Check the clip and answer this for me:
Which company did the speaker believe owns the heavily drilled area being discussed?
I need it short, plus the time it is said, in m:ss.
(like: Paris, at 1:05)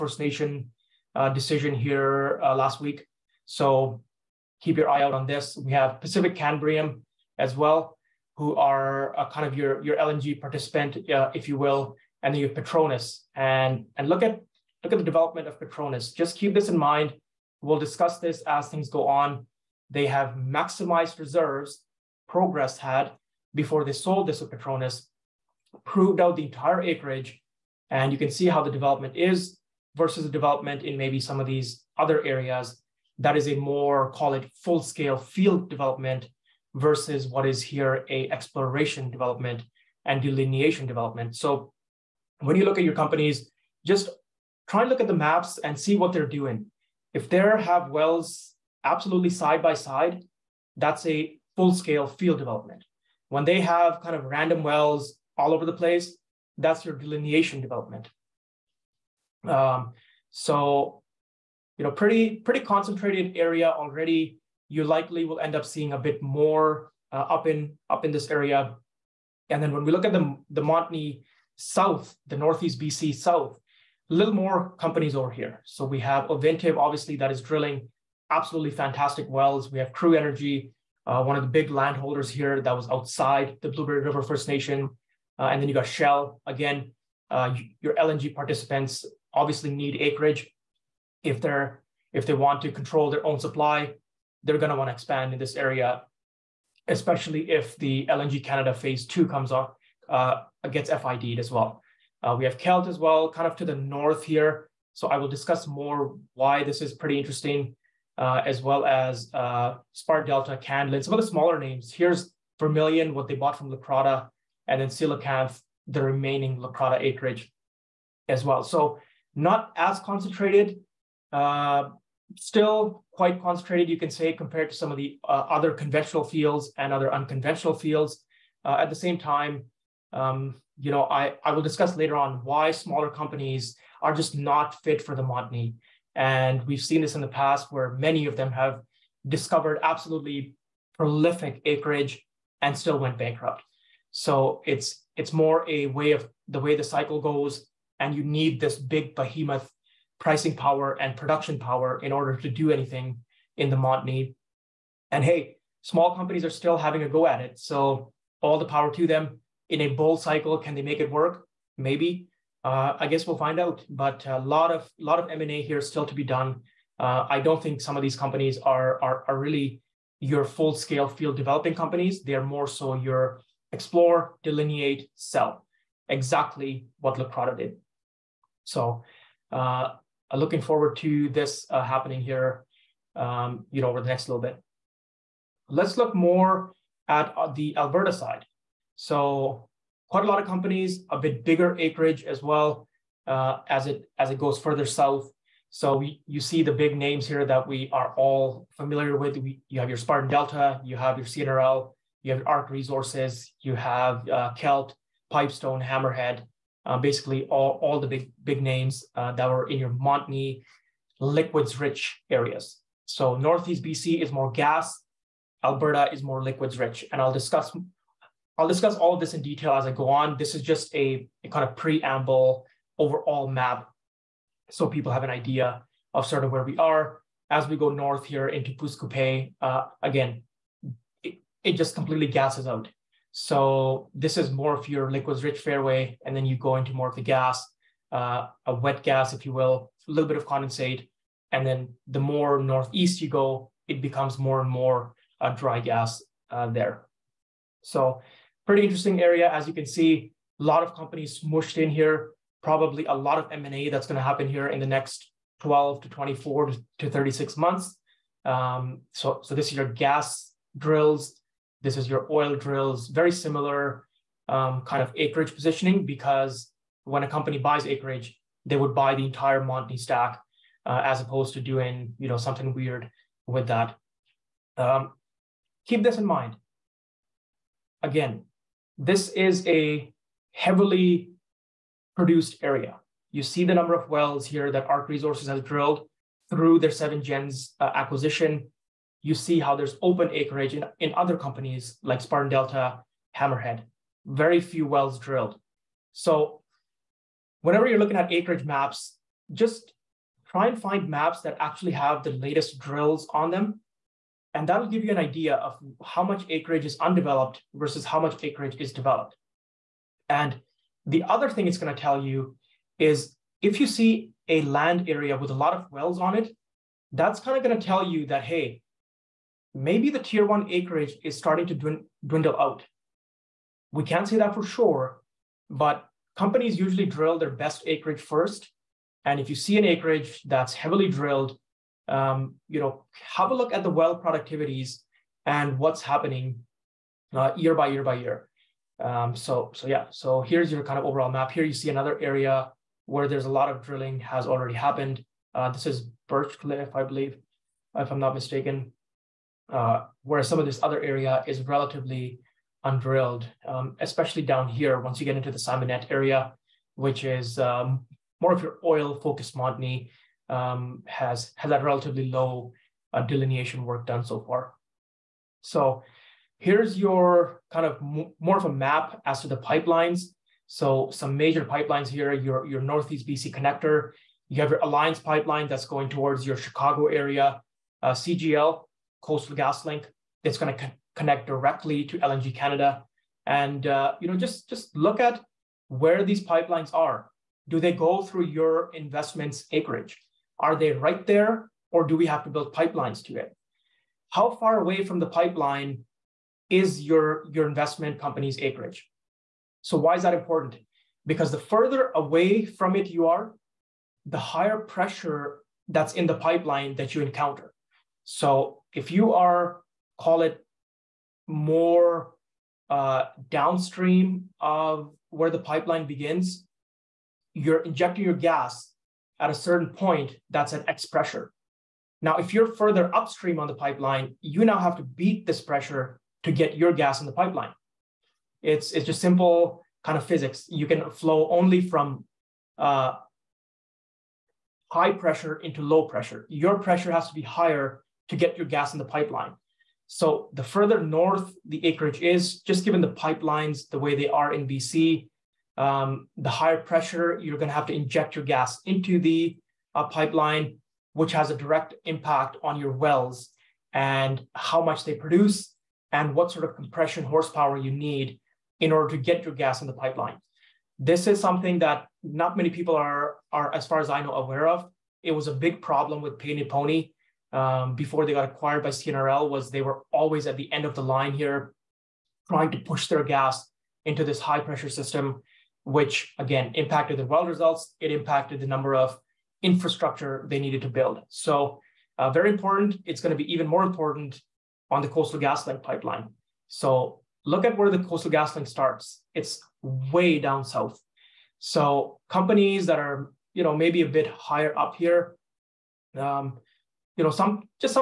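Birch Cliff, at 5:46.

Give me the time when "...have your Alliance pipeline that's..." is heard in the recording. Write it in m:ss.
6:14.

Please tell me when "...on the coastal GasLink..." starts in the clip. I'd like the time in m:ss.
8:04.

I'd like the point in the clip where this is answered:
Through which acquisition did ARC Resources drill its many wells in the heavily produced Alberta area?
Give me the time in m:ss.
4:46.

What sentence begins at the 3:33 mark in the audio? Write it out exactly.
So Northeast BC is more gas, Alberta is more liquids rich.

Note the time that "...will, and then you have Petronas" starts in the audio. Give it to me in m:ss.
0:11.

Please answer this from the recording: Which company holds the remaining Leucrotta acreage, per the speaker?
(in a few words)
Coelacanth.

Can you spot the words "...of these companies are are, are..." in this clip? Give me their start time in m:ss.
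2:47.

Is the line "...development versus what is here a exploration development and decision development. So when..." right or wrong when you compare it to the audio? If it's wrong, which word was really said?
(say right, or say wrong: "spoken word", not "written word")
wrong: "delineation", not "decision".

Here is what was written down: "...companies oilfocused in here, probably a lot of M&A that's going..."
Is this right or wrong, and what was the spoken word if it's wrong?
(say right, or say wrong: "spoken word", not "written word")
wrong: "mushed", not "oilfocused".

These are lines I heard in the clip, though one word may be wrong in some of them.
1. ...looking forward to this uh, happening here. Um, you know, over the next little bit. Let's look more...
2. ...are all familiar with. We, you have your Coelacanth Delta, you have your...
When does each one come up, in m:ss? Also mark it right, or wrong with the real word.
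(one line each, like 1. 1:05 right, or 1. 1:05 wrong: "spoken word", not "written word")
1. 3:00 right
2. 3:17 wrong: "Spartan", not "Coelacanth".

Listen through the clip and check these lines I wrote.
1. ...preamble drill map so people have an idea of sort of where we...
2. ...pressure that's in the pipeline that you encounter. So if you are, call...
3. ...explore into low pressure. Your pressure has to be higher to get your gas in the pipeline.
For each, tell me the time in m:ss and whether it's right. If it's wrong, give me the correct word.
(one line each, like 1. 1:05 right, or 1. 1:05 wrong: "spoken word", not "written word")
1. 3:41 wrong: "overall", not "drill"
2. 6:44 right
3. 7:15 wrong: "pressure", not "explore".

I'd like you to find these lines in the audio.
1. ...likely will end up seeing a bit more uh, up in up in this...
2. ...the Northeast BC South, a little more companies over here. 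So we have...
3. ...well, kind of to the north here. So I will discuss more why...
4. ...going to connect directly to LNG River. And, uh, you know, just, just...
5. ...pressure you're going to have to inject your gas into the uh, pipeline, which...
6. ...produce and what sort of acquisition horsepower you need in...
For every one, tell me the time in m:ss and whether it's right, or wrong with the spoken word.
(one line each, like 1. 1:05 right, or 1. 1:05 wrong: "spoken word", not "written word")
1. 1:04 right
2. 1:12 right
3. 1:42 right
4. 6:20 wrong: "Canada", not "River"
5. 7:26 right
6. 7:35 wrong: "compression", not "acquisition".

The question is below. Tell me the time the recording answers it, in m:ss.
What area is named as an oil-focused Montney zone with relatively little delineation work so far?
5:55.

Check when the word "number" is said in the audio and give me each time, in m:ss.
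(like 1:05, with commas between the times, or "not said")
4:43, 7:58.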